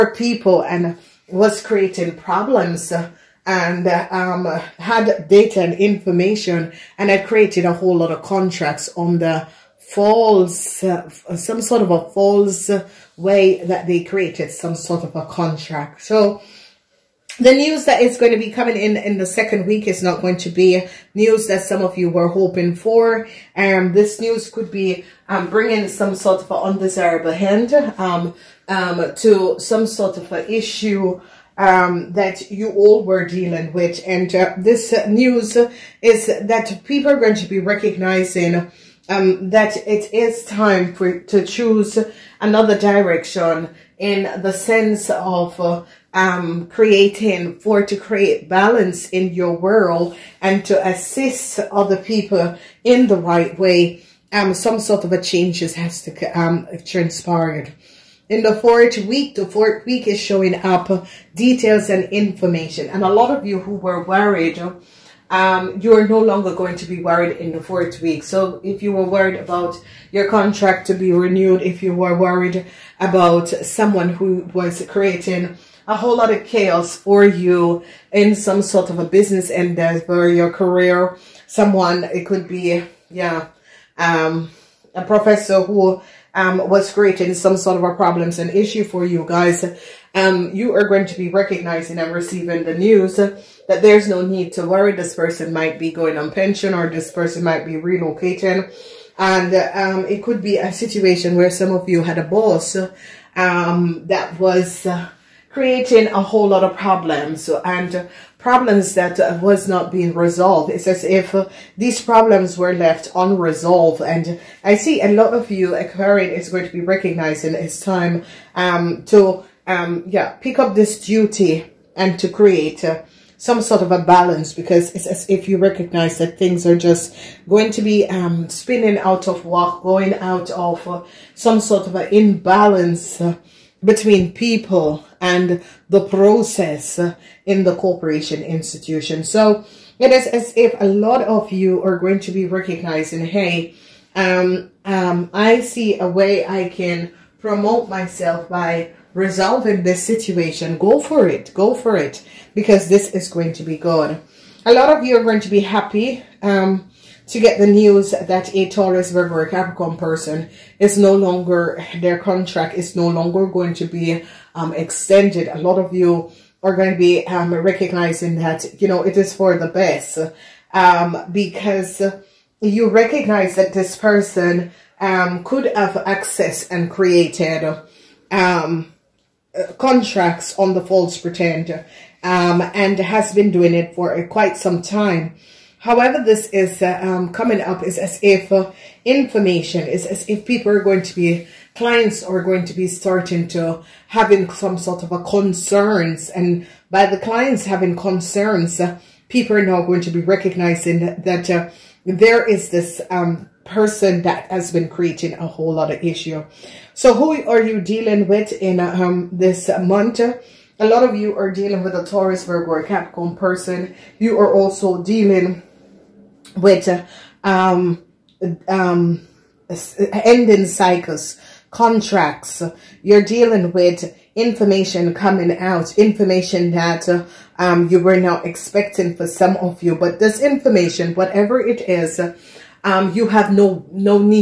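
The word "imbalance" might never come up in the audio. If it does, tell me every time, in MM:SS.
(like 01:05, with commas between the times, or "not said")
02:12.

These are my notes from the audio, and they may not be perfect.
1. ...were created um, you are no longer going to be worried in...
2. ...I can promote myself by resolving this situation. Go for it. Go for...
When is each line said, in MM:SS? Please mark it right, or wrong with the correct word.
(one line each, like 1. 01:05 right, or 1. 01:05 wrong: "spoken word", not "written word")
1. 01:03 wrong: "worried", not "created"
2. 02:26 right.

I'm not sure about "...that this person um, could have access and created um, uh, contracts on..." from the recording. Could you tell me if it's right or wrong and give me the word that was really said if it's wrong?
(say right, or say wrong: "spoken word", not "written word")
right.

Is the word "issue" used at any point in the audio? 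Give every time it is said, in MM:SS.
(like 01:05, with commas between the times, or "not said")
00:30, 01:28, 03:26.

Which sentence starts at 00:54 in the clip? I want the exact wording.
Um, some sort of a changes has to um, transpired.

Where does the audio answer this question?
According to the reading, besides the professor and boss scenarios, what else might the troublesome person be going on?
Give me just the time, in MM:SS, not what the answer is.
01:36.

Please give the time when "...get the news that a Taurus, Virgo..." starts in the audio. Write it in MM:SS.
02:37.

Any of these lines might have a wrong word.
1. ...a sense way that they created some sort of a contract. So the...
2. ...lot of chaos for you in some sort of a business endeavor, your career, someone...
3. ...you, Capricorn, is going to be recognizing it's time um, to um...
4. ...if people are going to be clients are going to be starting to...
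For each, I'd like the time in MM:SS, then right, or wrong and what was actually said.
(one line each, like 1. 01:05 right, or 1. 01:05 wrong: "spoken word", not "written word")
1. 00:11 wrong: "false", not "sense"
2. 01:16 right
3. 01:55 wrong: "Aquarian", not "Capricorn"
4. 03:10 right.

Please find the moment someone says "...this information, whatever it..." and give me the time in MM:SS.
03:50.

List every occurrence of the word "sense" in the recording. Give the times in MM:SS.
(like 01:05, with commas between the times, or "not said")
00:44.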